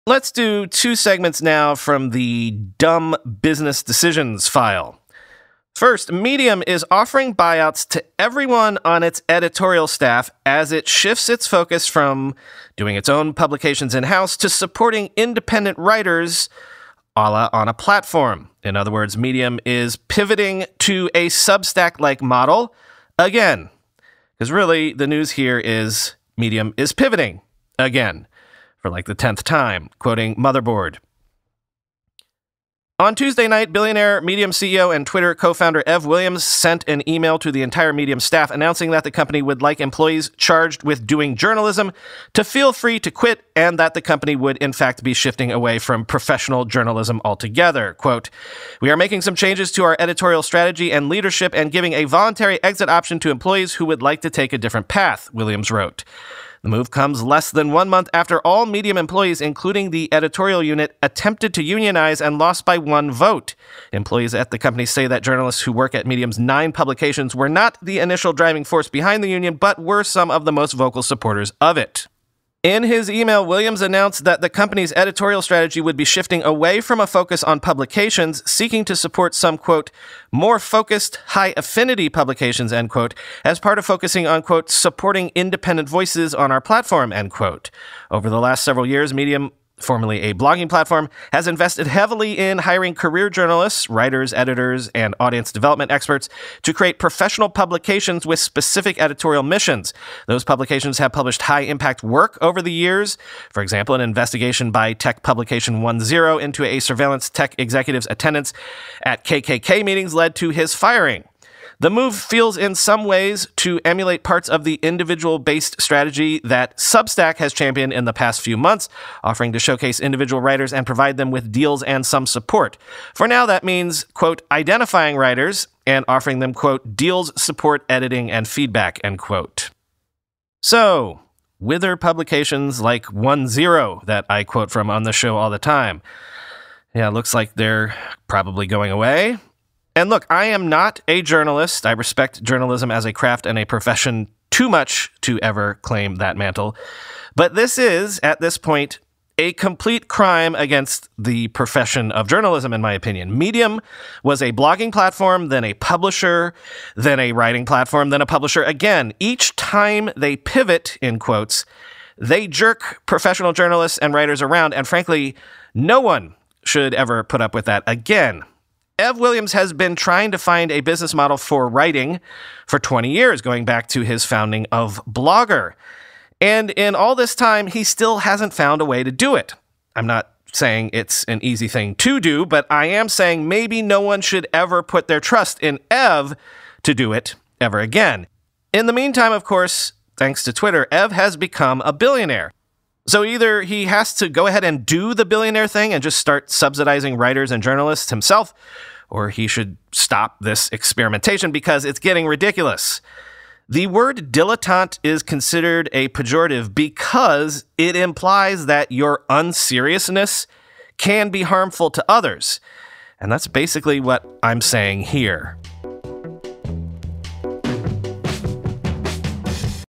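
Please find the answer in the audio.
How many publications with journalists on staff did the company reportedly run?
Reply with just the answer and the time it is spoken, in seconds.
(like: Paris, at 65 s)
9, at 66 s.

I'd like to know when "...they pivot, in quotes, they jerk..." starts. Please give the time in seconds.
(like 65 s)
160 s.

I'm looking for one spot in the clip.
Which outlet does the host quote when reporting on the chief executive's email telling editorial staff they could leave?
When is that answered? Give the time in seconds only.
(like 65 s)
30 s.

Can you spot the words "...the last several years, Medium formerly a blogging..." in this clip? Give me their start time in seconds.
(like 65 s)
88 s.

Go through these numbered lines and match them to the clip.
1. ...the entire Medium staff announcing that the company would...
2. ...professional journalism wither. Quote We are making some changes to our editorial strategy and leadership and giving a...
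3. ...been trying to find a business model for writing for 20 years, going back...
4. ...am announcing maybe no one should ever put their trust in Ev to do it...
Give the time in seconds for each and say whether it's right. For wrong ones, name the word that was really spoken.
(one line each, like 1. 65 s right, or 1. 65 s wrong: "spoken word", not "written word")
1. 37 s right
2. 46 s wrong: "altogether", not "wither"
3. 169 s right
4. 182 s wrong: "saying", not "announcing".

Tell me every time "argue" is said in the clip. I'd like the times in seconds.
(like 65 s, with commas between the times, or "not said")
not said.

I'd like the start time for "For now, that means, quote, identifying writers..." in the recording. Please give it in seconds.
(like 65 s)
123 s.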